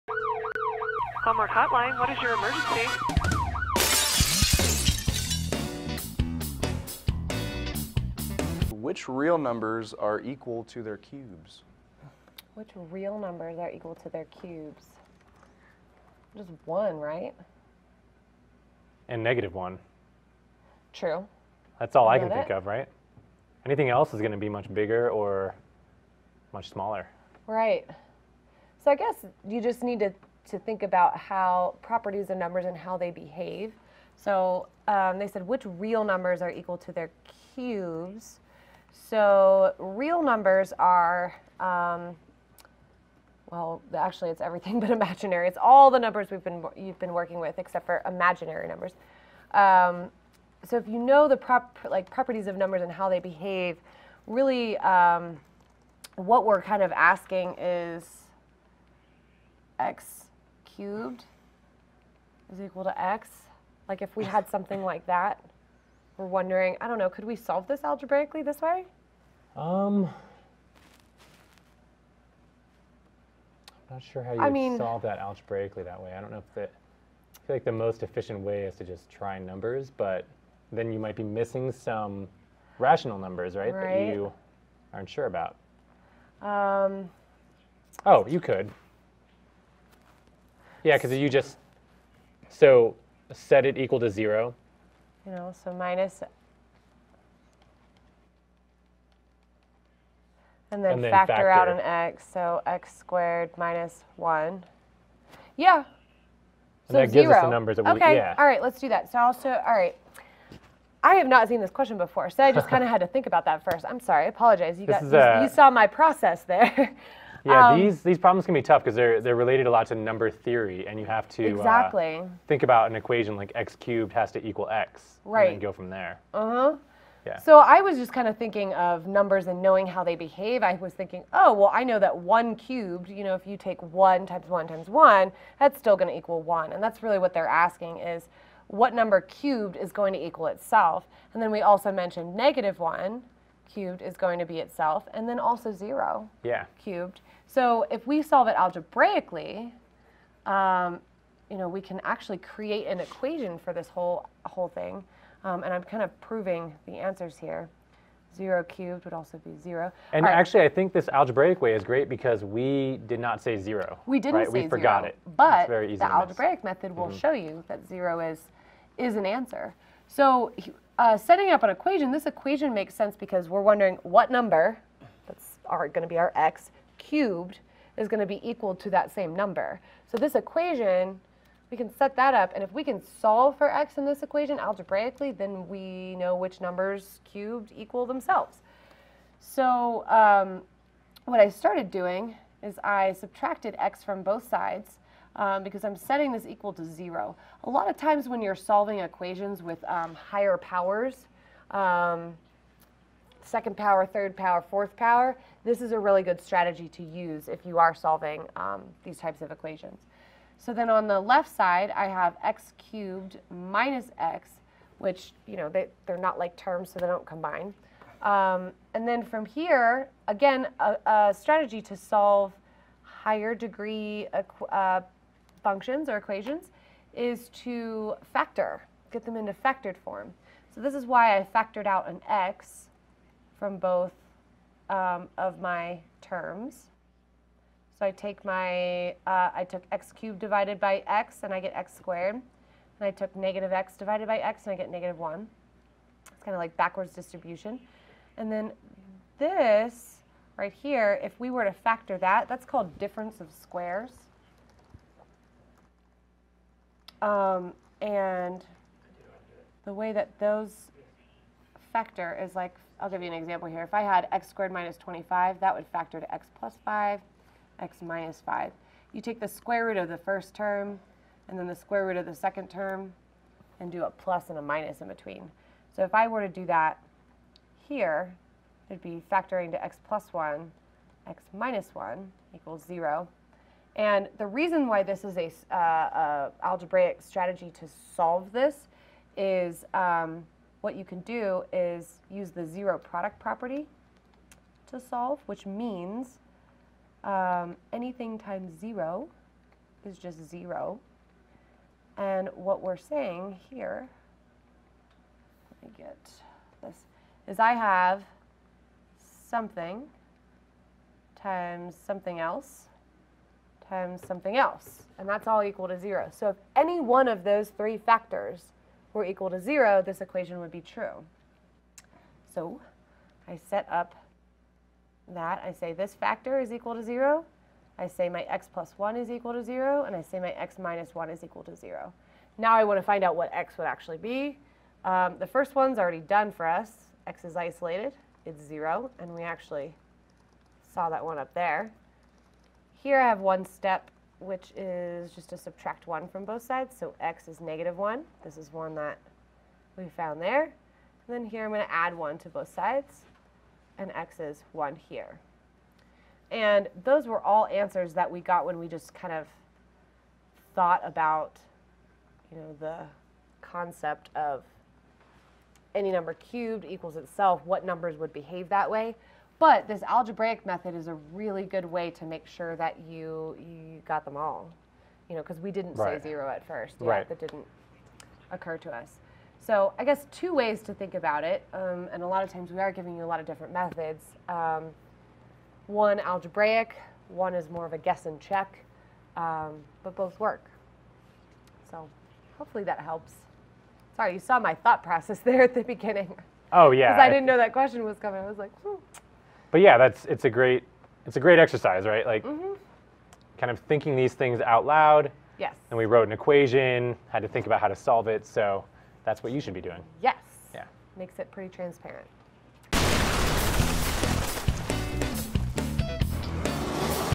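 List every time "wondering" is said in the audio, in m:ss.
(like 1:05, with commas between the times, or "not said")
1:06, 2:53.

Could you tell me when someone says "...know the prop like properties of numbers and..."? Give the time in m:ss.
0:50.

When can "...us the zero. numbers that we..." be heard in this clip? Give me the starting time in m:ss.
1:47.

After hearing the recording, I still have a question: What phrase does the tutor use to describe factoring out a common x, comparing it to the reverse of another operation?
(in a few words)
backwards distribution.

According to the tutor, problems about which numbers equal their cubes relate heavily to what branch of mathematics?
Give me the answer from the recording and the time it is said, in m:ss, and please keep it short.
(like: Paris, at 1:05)
number theory, at 1:59.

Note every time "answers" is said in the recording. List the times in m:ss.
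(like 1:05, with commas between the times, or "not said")
2:36, 2:49, 5:57.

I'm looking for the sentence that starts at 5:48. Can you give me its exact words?
This is one that we found there.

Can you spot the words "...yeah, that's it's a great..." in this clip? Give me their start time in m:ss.
6:39.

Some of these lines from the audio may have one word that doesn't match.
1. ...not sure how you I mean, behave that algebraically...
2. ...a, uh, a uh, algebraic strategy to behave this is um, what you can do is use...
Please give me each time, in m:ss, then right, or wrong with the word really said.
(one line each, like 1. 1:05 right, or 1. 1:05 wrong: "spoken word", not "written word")
1. 1:13 wrong: "solve", not "behave"
2. 4:45 wrong: "solve", not "behave".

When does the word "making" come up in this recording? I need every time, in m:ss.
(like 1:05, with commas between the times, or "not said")
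not said.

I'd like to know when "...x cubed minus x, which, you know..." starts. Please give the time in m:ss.
3:32.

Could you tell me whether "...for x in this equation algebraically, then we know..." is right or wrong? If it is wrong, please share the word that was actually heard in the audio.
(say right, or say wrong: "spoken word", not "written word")
right.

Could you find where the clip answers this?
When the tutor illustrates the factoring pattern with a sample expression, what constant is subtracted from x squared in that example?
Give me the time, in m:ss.
4:24.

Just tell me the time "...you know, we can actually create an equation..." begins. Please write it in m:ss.
2:31.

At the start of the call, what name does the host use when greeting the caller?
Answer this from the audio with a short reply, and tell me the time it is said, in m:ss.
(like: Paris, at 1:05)
Homework Hotline, at 0:01.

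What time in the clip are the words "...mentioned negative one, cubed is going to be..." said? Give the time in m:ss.
2:21.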